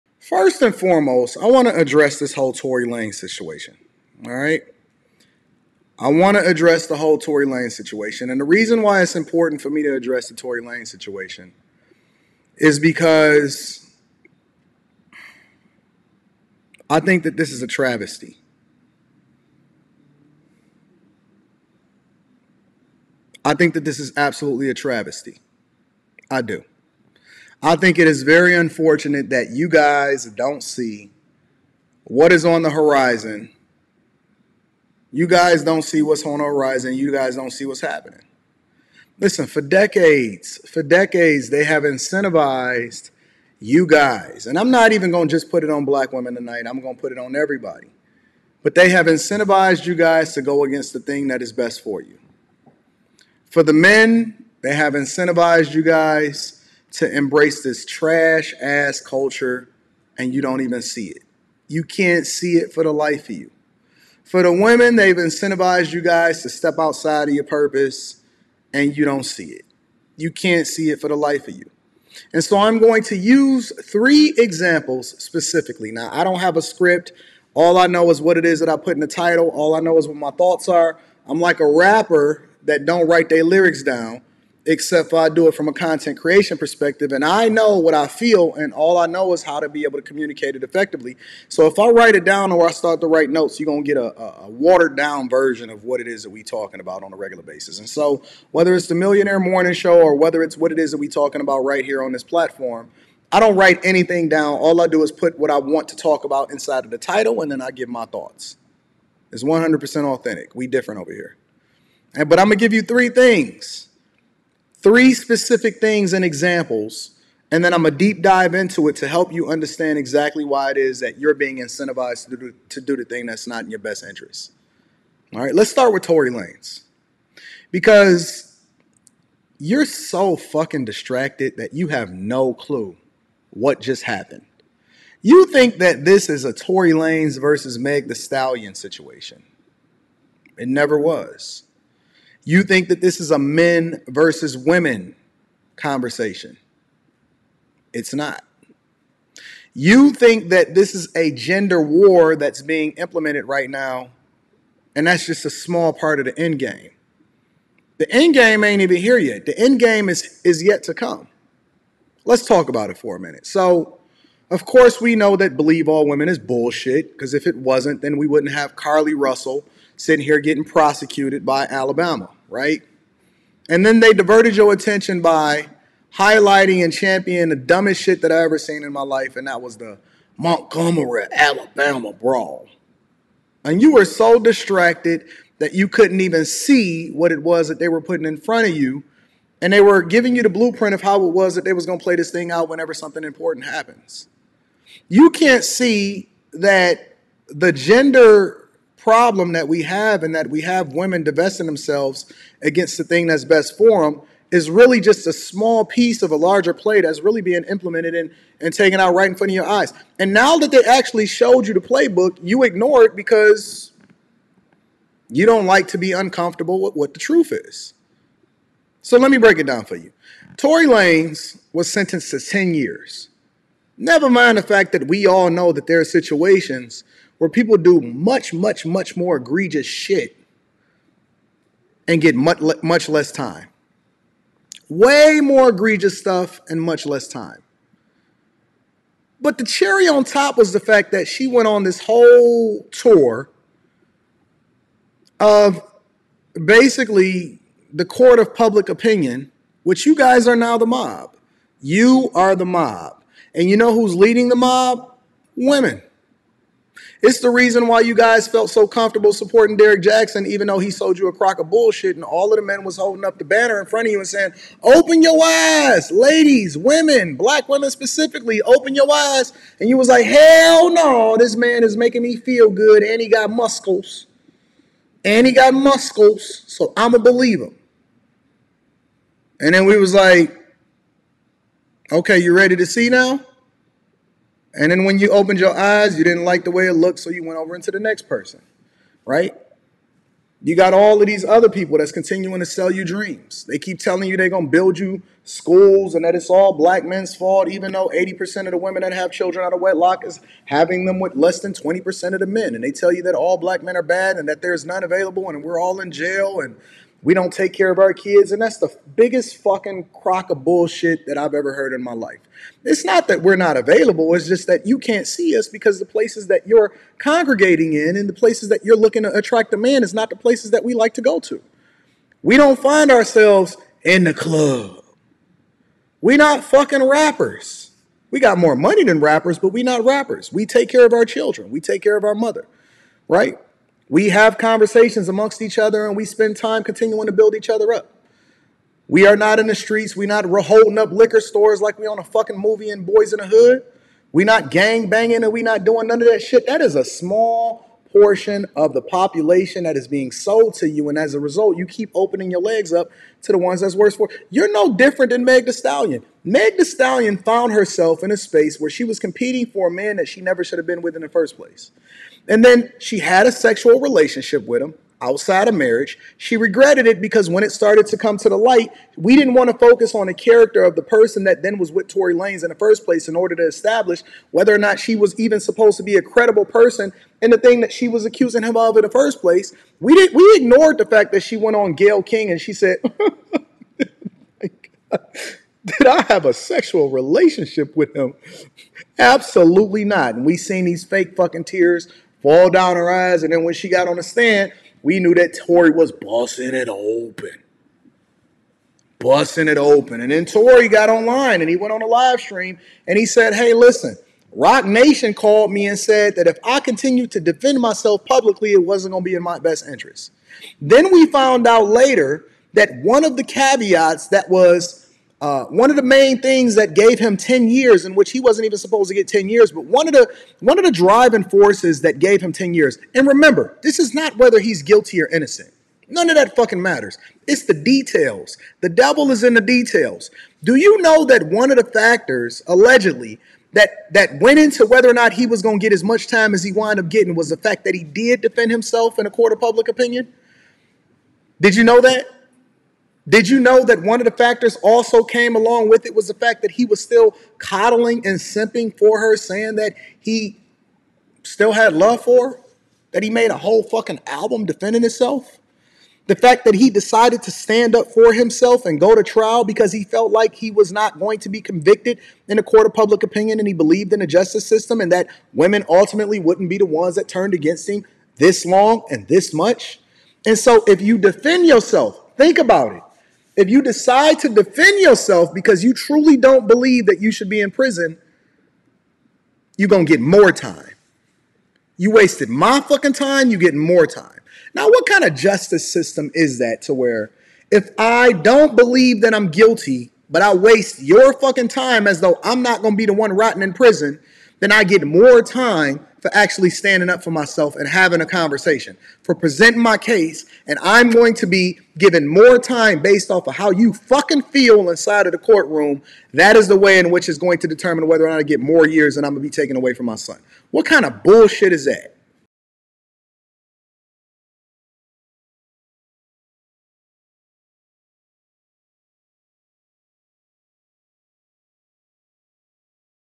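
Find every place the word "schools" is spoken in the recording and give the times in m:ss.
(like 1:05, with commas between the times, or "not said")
4:55.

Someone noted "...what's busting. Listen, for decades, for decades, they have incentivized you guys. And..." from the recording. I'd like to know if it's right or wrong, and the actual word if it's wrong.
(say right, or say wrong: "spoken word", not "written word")
wrong: "happening", not "busting".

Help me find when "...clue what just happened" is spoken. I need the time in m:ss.
2:12.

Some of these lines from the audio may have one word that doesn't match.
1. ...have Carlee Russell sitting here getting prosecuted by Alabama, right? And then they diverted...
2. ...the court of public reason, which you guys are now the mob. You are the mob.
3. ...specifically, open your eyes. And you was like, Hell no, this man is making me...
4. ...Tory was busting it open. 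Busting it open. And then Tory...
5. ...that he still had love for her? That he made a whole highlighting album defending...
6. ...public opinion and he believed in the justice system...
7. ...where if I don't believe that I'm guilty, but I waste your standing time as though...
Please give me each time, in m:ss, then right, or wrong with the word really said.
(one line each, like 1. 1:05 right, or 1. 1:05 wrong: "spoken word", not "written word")
1. 2:48 right
2. 4:07 wrong: "opinion", not "reason"
3. 4:27 right
4. 6:35 right
5. 7:29 wrong: "fucking", not "highlighting"
6. 7:42 right
7. 8:06 wrong: "fucking", not "standing".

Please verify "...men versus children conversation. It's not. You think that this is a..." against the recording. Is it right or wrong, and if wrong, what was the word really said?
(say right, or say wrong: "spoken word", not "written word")
wrong: "women", not "children".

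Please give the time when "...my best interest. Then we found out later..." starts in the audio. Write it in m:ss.
6:49.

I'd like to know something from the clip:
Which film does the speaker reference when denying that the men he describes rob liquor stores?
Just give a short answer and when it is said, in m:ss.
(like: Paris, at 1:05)
Boys in the Hood, at 5:43.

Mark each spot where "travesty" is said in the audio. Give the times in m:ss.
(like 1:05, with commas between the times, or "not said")
0:17, 0:24.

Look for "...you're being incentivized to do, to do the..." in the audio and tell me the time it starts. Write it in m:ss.
2:01.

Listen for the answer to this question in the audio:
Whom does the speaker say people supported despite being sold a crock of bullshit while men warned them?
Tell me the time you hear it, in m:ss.
4:19.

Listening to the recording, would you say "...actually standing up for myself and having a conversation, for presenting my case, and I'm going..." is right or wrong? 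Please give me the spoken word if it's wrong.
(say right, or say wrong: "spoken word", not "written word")
right.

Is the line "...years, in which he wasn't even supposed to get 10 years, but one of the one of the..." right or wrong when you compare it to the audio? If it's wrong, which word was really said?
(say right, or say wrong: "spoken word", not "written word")
right.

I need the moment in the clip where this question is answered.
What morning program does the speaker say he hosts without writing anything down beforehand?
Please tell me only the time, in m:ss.
1:38.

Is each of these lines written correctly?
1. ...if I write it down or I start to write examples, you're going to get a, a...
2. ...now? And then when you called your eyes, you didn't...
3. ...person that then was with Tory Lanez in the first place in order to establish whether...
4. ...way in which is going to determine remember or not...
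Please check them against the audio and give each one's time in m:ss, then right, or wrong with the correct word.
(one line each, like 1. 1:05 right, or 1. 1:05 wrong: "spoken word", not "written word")
1. 1:31 wrong: "notes", not "examples"
2. 4:43 wrong: "opened", not "called"
3. 6:11 right
4. 8:26 wrong: "whether", not "remember".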